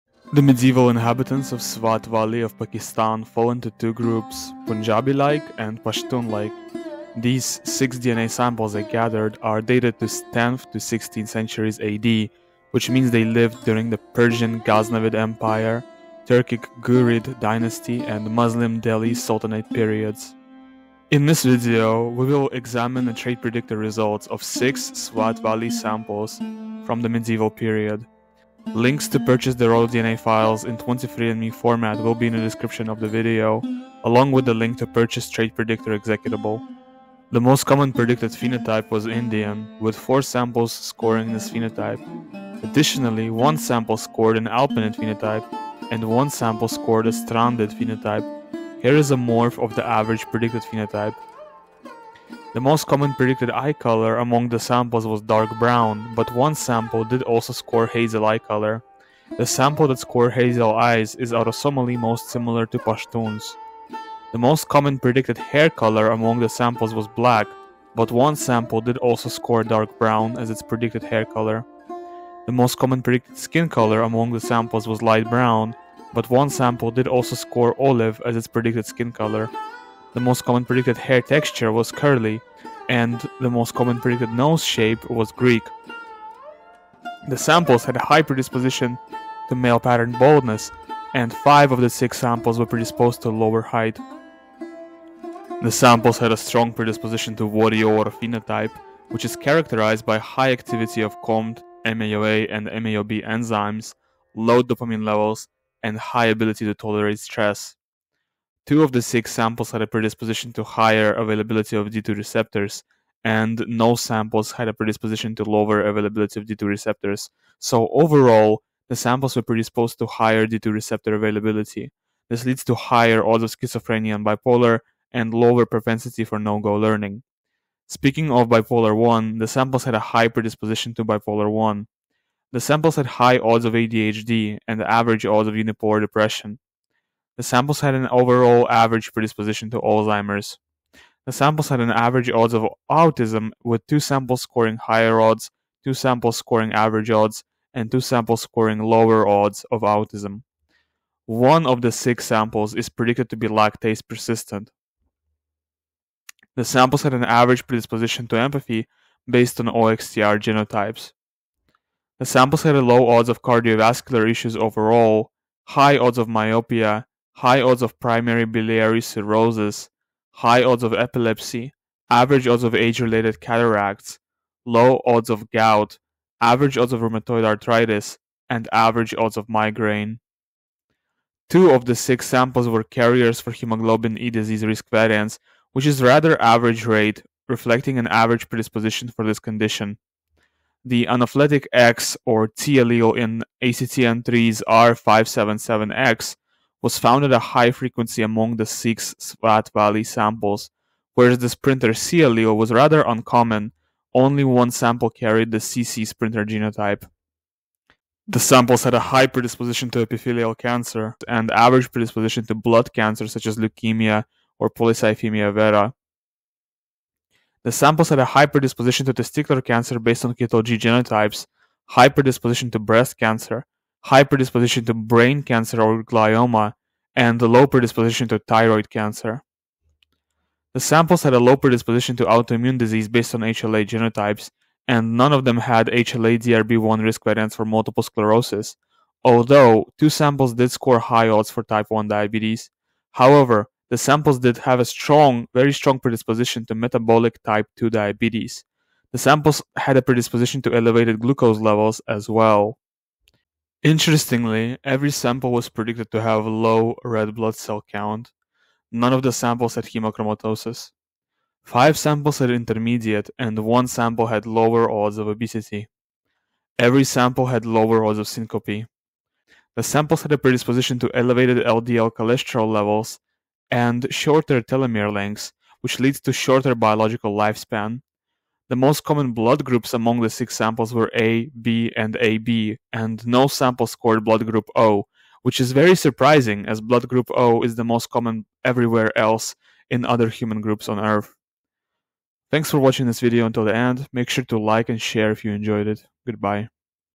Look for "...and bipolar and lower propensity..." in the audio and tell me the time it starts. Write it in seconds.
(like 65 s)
124 s.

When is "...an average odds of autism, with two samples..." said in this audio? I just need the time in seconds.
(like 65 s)
141 s.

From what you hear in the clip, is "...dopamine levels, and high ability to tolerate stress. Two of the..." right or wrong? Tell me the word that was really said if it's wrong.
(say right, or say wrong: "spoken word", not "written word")
right.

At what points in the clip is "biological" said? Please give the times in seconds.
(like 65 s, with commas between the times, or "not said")
276 s.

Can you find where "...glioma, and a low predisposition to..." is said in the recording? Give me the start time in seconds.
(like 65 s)
226 s.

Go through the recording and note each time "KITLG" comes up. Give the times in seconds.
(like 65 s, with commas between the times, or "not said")
220 s.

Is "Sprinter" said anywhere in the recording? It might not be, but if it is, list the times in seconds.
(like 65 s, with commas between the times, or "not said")
201 s, 206 s.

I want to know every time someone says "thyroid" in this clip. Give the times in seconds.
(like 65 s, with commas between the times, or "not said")
228 s.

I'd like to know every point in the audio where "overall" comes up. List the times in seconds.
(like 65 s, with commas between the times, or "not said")
117 s, 138 s, 164 s.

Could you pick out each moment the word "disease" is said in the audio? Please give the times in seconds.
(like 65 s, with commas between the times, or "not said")
184 s, 232 s.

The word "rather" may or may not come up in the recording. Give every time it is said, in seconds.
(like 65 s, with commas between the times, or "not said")
186 s, 202 s.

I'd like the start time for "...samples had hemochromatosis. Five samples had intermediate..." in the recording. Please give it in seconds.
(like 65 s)
259 s.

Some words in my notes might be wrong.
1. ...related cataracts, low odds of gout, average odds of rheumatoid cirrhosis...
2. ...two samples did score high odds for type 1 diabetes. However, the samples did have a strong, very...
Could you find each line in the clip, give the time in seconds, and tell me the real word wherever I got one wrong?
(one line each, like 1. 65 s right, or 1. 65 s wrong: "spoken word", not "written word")
1. 172 s wrong: "arthritis", not "cirrhosis"
2. 239 s right.